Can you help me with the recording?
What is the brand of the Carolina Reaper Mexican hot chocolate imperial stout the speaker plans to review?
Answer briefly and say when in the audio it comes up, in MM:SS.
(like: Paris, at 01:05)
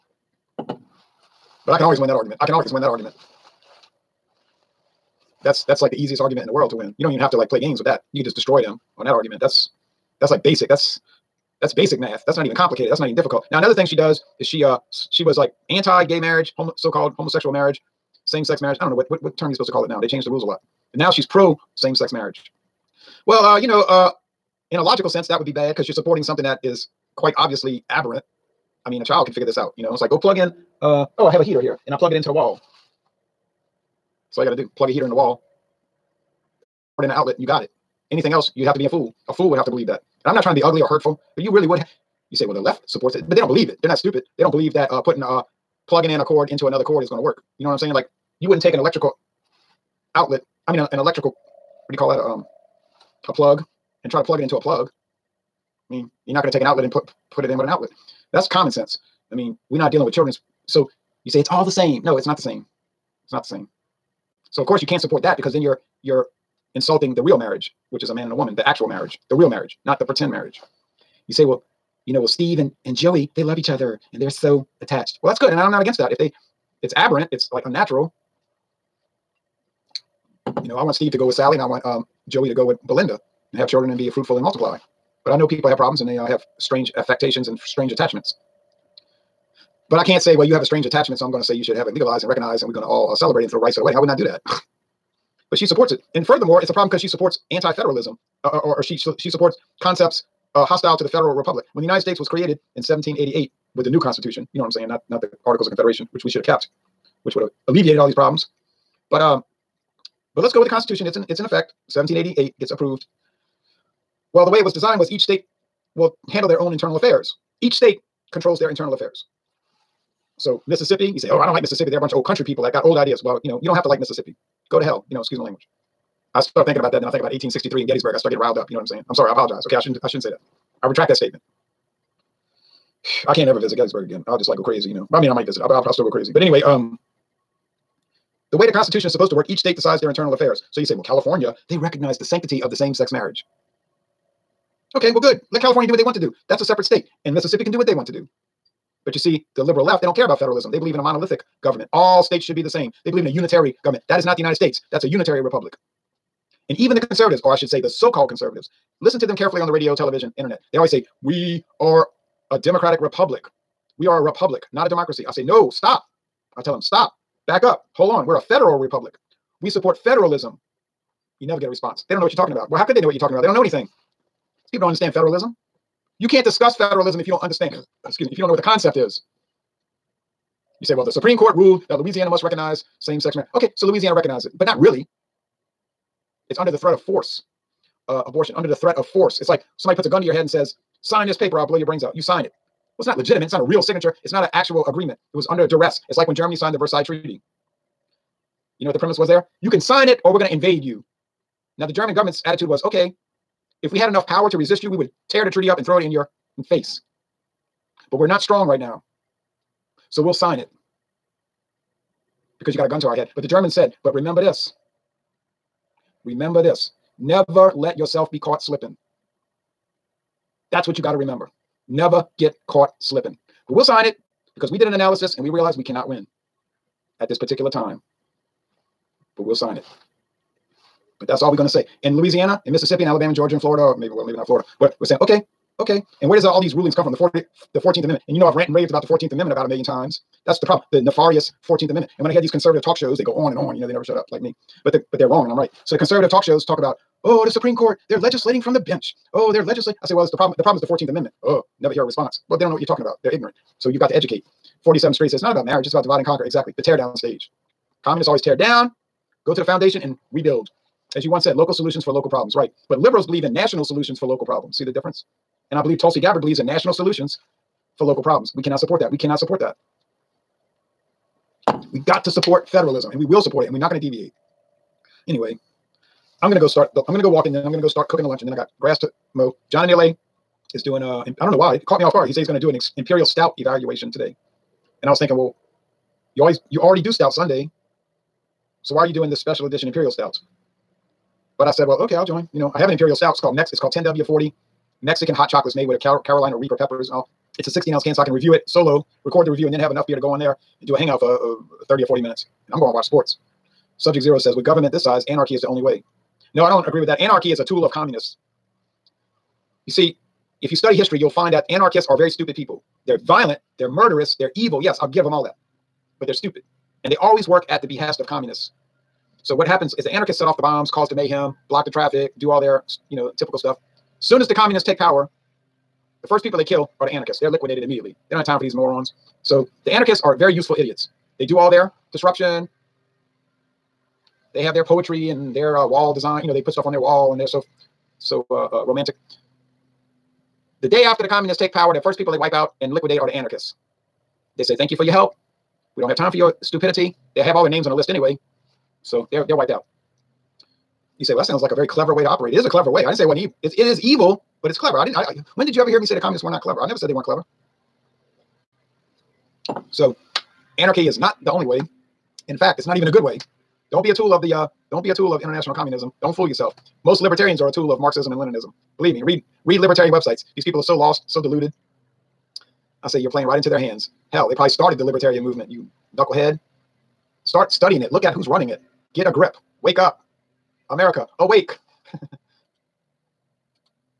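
10W40, at 04:53.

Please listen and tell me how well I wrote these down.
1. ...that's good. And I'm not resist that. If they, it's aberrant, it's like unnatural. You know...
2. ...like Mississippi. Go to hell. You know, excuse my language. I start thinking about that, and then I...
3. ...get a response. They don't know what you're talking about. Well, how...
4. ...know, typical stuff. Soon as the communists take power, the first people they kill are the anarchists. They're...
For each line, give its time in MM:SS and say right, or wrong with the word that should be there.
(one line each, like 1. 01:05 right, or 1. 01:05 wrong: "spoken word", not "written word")
1. 01:15 wrong: "against", not "resist"
2. 02:03 right
3. 02:51 right
4. 05:23 right.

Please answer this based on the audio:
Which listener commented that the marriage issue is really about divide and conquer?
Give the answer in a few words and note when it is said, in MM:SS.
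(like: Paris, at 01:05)
47 Street, at 04:14.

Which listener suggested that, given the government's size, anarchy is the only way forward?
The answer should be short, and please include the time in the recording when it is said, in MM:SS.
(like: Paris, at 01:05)
Subject Zero, at 05:03.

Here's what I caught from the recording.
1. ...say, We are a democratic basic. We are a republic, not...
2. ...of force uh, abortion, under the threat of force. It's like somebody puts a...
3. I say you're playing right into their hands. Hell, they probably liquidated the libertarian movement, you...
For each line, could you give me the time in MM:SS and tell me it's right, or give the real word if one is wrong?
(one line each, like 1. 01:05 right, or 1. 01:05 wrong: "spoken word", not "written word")
1. 02:40 wrong: "republic", not "basic"
2. 03:06 right
3. 06:13 wrong: "started", not "liquidated".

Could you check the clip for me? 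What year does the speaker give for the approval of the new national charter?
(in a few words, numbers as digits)
1788.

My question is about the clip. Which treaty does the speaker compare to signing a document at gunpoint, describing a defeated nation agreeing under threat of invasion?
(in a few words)
Versailles Treaty.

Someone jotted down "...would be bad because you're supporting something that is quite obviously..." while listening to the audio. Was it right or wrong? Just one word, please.
right.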